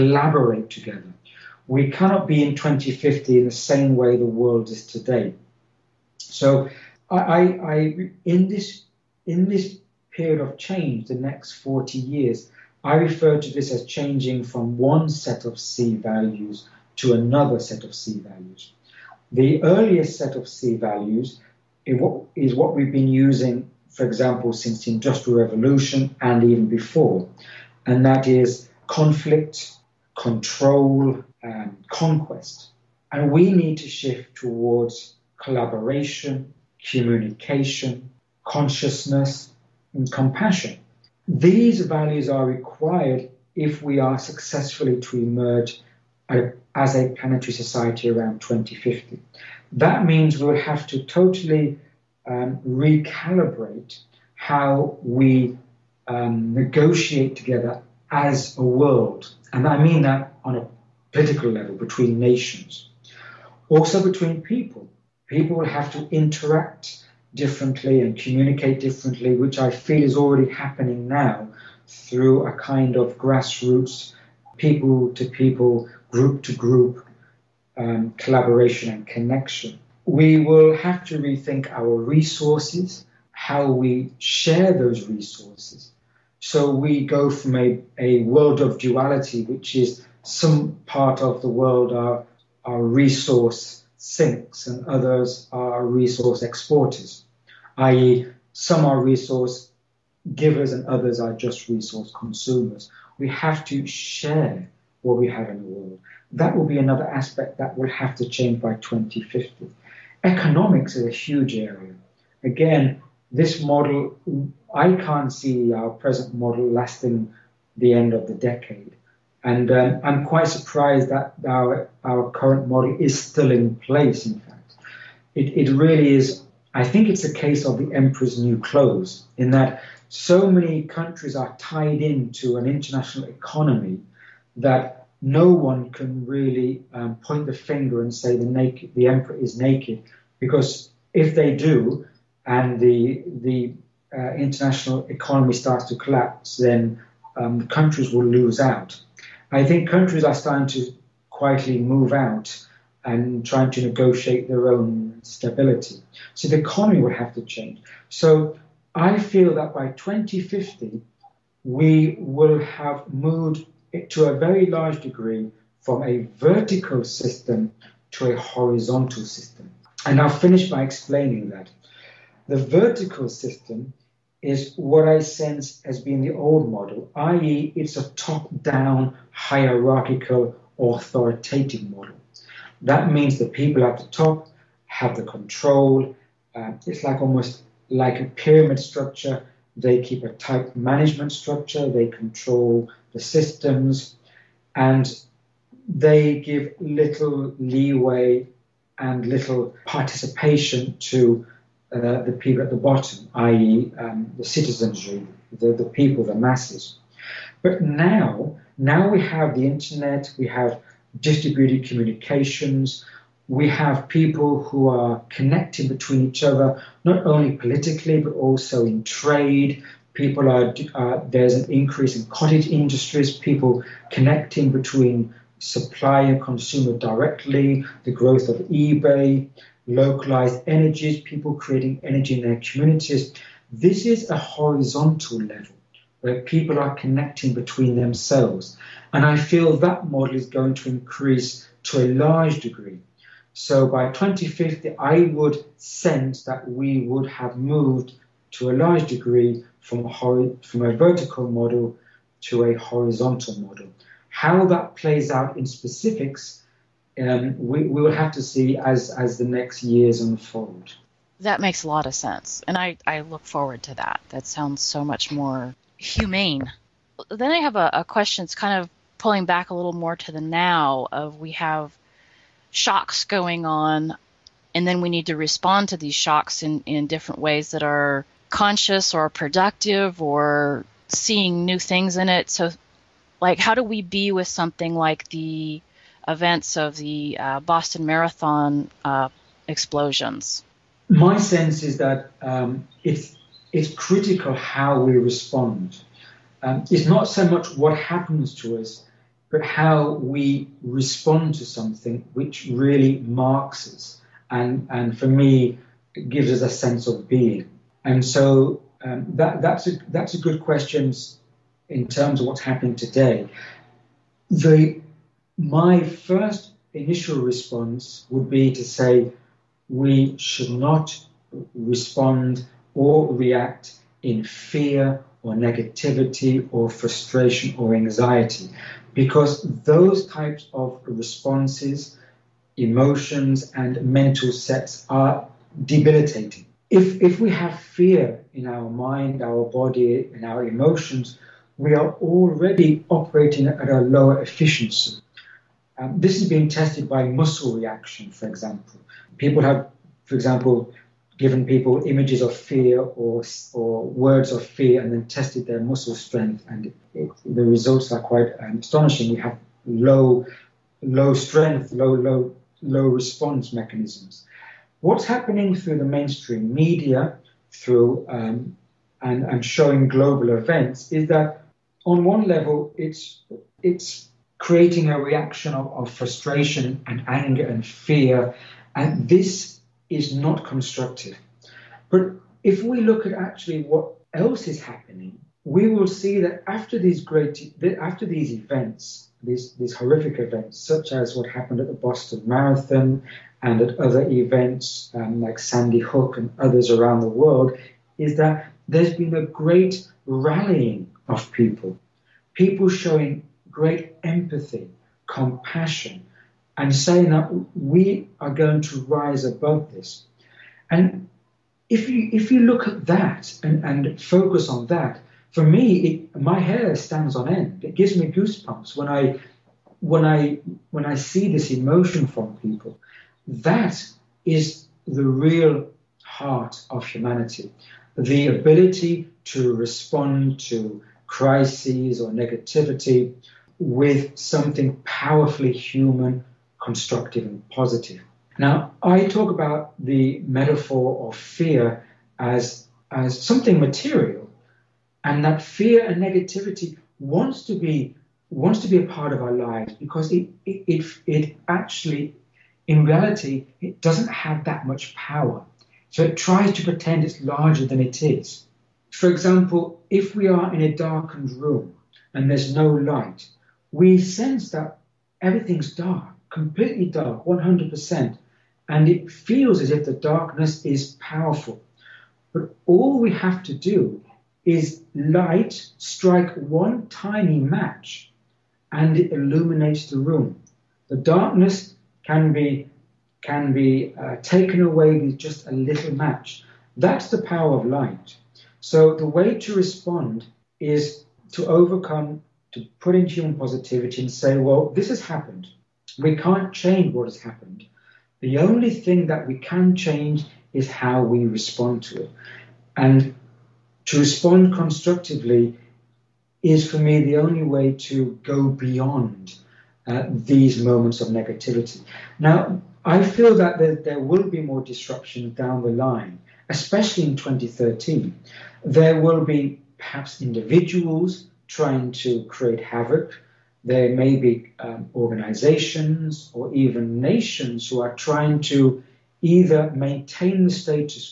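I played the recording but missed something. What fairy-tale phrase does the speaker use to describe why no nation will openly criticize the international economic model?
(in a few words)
the emperor's new clothes.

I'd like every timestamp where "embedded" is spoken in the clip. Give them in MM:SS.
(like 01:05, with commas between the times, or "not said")
not said.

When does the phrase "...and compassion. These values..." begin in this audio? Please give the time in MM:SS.
00:39.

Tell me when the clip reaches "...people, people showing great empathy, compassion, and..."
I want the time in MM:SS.
06:41.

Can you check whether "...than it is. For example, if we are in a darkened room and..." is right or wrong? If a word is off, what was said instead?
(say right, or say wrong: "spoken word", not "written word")
right.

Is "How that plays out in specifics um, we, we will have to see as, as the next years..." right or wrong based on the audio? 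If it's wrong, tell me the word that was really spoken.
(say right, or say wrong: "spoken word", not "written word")
right.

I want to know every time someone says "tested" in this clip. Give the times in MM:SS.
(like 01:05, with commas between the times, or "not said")
05:46, 05:55.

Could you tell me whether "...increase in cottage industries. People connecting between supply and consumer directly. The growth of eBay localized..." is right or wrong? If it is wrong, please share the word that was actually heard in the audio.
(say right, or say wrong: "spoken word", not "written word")
right.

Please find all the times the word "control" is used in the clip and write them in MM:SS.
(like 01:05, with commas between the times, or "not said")
00:30, 03:05, 03:12.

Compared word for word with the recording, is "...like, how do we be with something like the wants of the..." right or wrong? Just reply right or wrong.
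wrong.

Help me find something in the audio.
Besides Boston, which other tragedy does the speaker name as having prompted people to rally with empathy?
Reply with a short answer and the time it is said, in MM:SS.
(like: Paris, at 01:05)
Sandy Hook, at 06:35.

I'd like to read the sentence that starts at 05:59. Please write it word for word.
We have low, low strength, low, low, low response mechanisms.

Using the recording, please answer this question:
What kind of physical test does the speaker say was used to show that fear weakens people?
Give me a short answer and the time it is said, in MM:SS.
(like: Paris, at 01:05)
muscle reaction, at 05:47.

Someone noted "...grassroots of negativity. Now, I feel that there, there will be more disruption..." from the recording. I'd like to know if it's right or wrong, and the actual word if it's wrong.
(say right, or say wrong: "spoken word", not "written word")
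wrong: "moments", not "grassroots".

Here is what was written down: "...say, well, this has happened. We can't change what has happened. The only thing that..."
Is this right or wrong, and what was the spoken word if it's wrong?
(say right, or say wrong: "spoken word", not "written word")
right.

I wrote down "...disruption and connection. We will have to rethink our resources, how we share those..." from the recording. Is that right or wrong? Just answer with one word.
wrong.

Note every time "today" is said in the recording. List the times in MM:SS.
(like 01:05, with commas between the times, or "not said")
00:04, 05:12.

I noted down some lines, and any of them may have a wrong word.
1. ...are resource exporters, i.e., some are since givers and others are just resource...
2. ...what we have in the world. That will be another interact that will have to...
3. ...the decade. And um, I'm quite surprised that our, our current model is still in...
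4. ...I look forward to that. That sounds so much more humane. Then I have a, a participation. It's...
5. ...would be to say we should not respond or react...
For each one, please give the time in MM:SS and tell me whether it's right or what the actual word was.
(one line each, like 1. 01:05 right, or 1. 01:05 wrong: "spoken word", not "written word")
1. 01:35 wrong: "resource", not "since"
2. 01:45 wrong: "aspect", not "interact"
3. 01:58 right
4. 04:23 wrong: "question", not "participation"
5. 05:18 right.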